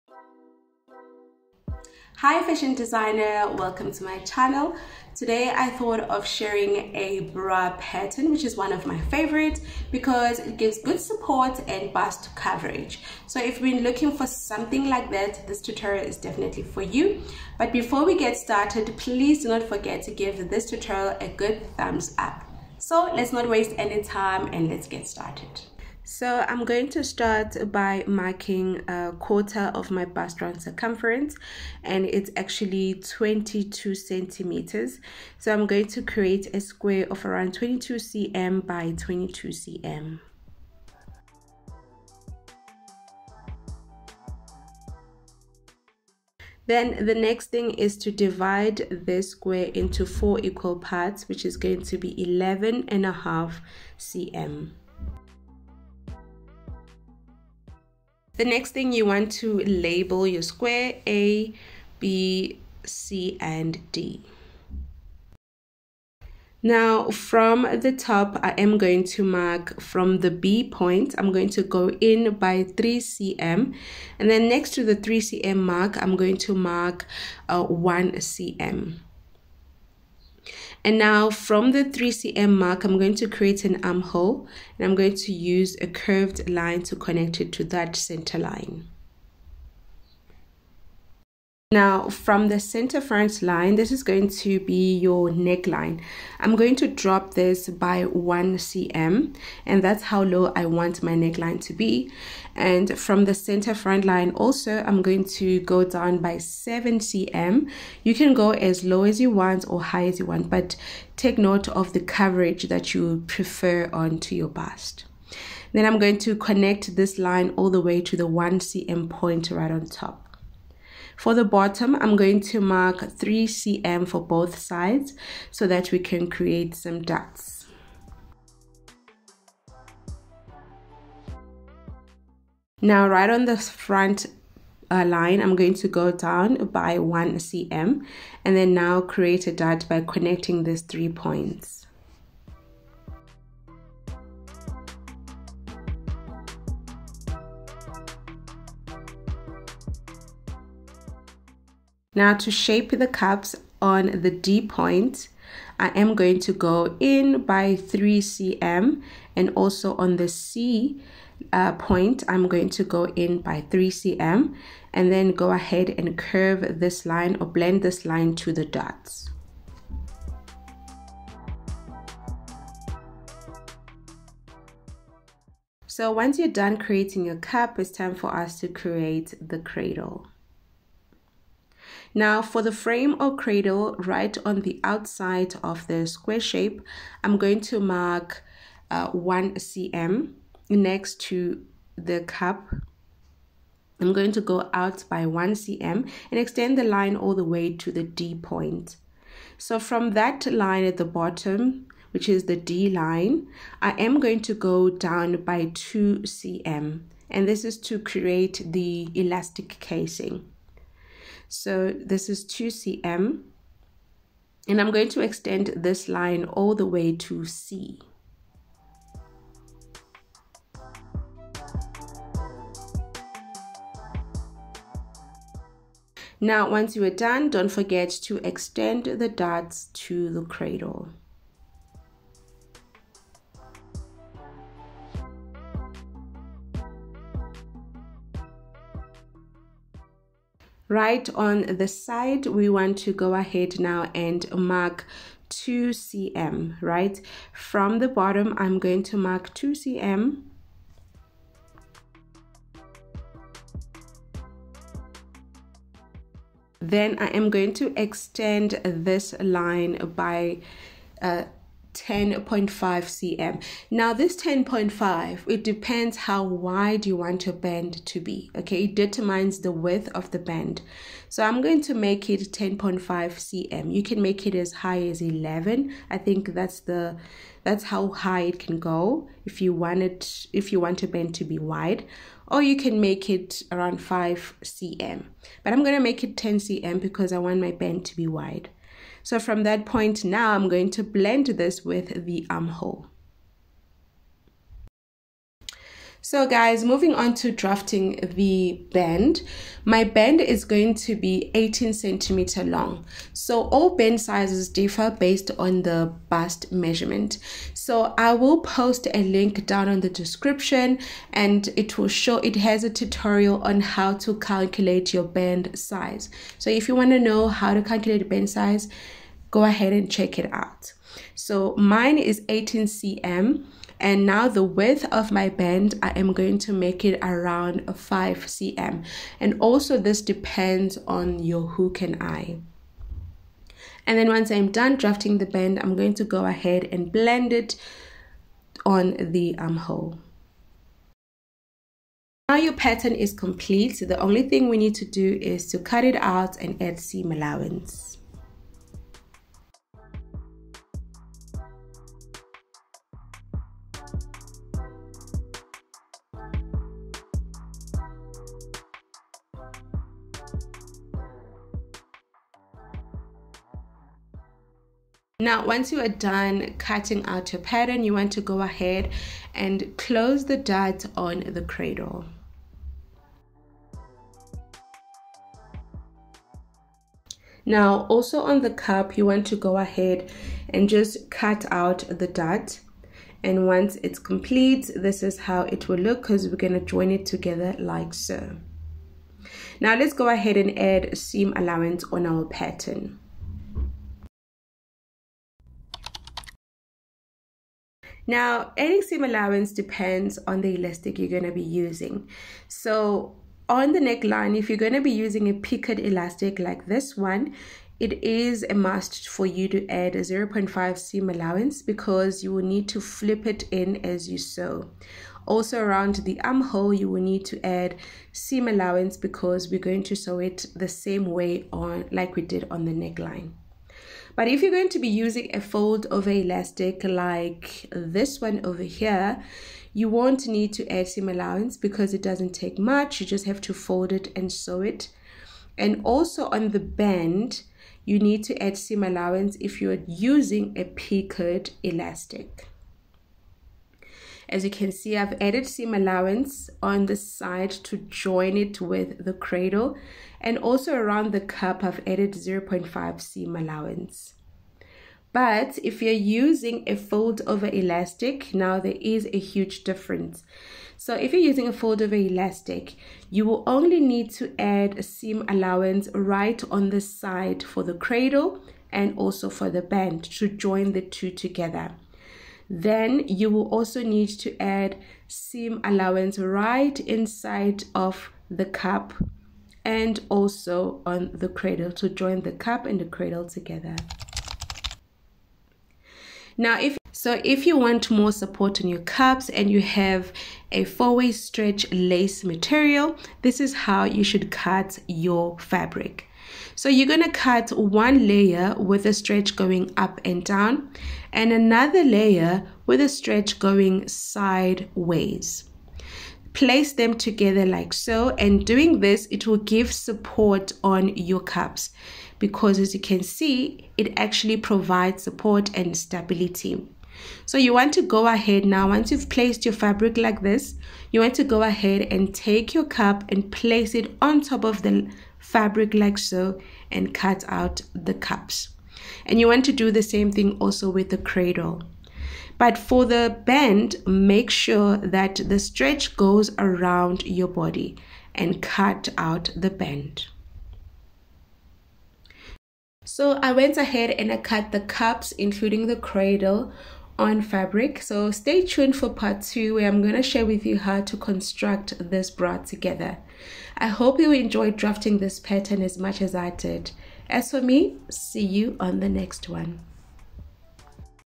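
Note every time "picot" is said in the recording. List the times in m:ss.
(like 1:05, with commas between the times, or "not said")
6:45, 7:20.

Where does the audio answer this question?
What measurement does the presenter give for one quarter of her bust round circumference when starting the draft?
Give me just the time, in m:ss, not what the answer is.
0:32.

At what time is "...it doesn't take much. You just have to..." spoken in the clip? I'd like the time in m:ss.
7:12.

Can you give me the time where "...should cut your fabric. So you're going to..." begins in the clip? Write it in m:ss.
8:14.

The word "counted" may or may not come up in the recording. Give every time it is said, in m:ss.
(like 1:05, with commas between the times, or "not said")
not said.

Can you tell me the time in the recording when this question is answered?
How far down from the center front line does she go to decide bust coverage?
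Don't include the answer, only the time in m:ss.
1:46.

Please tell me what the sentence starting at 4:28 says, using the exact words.
Okay, it determines the width of the band.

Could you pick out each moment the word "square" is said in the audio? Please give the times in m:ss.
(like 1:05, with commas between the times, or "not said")
0:36, 0:49, 1:00, 3:06.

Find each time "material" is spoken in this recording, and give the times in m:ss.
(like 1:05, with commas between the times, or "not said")
8:12.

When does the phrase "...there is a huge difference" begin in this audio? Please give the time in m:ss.
7:38.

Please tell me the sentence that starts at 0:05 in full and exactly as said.
Today I thought of sharing a bra pattern which is one of my favorites because it gives good support and bust coverage.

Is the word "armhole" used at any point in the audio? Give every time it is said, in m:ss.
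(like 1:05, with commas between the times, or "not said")
1:23, 4:52, 5:39, 6:56.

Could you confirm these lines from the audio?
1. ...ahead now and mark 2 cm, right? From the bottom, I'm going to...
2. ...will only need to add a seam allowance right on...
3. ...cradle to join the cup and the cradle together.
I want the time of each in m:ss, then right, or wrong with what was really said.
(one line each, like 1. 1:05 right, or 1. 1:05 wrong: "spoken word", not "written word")
1. 4:03 right
2. 7:43 right
3. 8:01 right.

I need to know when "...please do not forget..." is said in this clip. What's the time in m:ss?
0:18.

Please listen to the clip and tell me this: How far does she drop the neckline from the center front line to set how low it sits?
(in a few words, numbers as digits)
1 cm.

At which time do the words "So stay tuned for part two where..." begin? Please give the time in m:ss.
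9:08.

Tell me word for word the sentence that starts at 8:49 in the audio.
And you want to do the same thing also with the cradle.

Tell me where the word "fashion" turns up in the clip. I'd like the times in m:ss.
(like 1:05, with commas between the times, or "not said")
0:02.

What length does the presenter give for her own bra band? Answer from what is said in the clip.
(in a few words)
18 cm.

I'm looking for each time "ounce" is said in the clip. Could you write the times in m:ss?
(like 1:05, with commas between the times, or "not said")
not said.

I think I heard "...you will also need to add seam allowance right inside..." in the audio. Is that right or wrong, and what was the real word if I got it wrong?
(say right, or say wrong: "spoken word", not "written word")
right.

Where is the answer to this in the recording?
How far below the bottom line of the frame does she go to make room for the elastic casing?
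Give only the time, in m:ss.
3:24.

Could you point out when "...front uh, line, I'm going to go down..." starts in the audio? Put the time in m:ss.
2:13.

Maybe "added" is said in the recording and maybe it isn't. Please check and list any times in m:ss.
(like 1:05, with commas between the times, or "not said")
7:25, 7:32.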